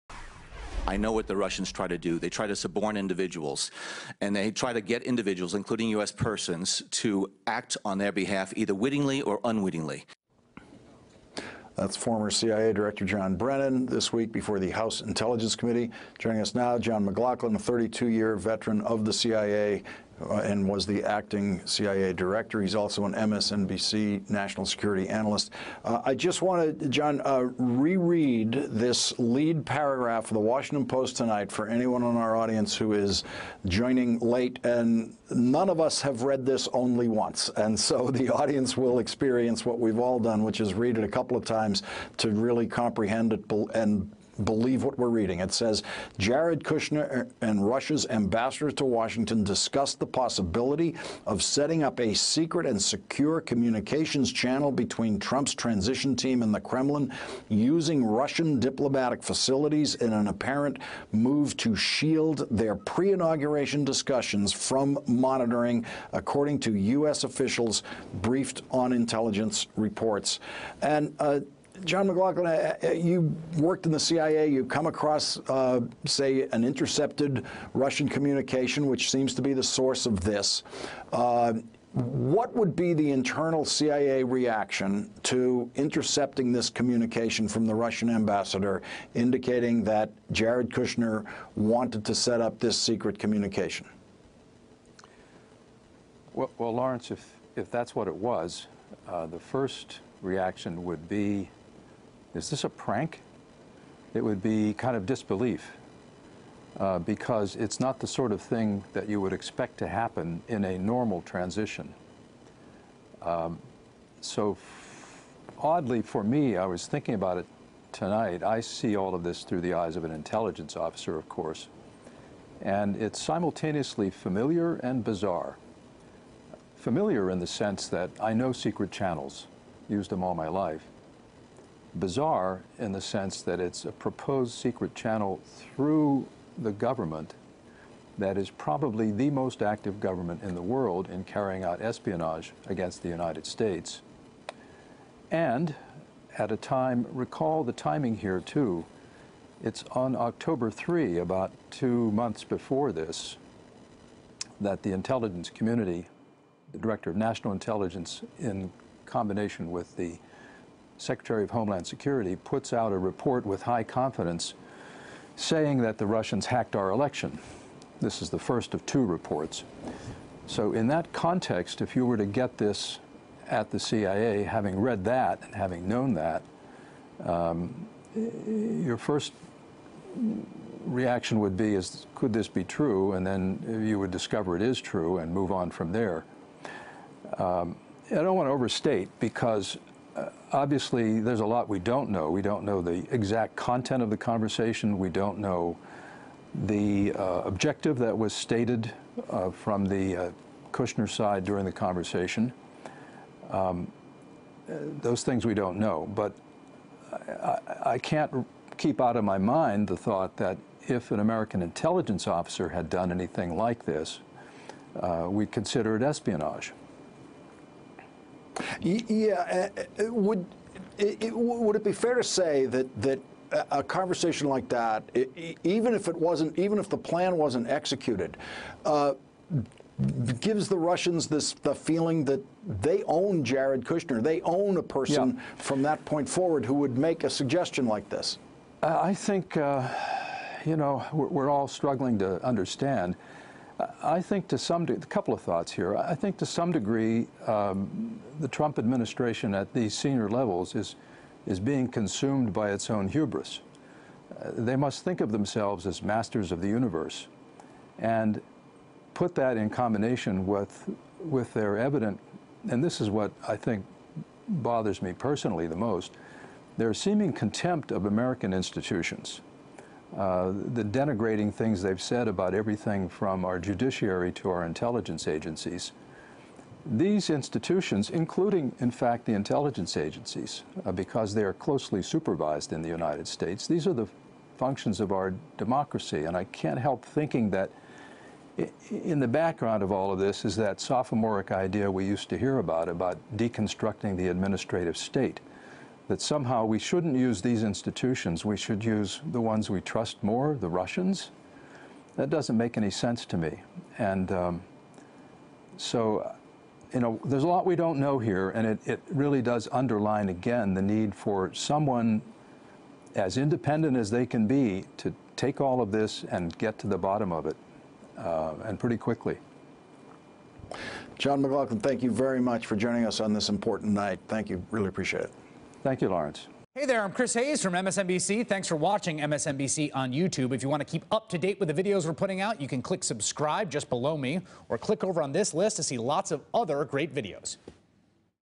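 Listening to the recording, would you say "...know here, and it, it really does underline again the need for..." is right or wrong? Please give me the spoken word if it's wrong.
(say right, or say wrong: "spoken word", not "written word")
right.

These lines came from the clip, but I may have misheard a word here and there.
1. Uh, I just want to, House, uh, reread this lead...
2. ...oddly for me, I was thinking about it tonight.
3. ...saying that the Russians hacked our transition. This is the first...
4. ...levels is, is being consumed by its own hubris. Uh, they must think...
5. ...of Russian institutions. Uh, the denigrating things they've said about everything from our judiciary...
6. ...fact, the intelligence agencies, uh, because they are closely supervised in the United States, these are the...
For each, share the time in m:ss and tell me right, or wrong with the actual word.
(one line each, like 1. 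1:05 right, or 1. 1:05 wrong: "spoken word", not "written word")
1. 0:25 wrong: "John", not "House"
2. 1:55 right
3. 2:45 wrong: "election", not "transition"
4. 4:10 right
5. 4:27 wrong: "American", not "Russian"
6. 4:38 right.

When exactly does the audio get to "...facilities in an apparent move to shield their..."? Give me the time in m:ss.
0:59.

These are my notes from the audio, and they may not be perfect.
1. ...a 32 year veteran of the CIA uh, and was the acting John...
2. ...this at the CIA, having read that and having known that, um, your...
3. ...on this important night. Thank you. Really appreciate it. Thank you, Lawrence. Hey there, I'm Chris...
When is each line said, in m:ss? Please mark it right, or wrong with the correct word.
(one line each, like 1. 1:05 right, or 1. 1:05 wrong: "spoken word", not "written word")
1. 0:17 wrong: "CIA", not "John"
2. 2:52 right
3. 5:23 right.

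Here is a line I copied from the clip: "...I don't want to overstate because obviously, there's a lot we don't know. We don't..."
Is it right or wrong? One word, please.
right.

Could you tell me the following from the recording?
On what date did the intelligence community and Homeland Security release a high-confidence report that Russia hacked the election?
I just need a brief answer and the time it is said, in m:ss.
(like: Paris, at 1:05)
October 3, at 2:30.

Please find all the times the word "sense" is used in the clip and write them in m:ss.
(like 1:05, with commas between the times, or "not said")
2:07, 2:13, 5:02.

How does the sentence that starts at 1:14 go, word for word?
You come across, uh, say, an intercepted Russian communication, which seems to be the source of this.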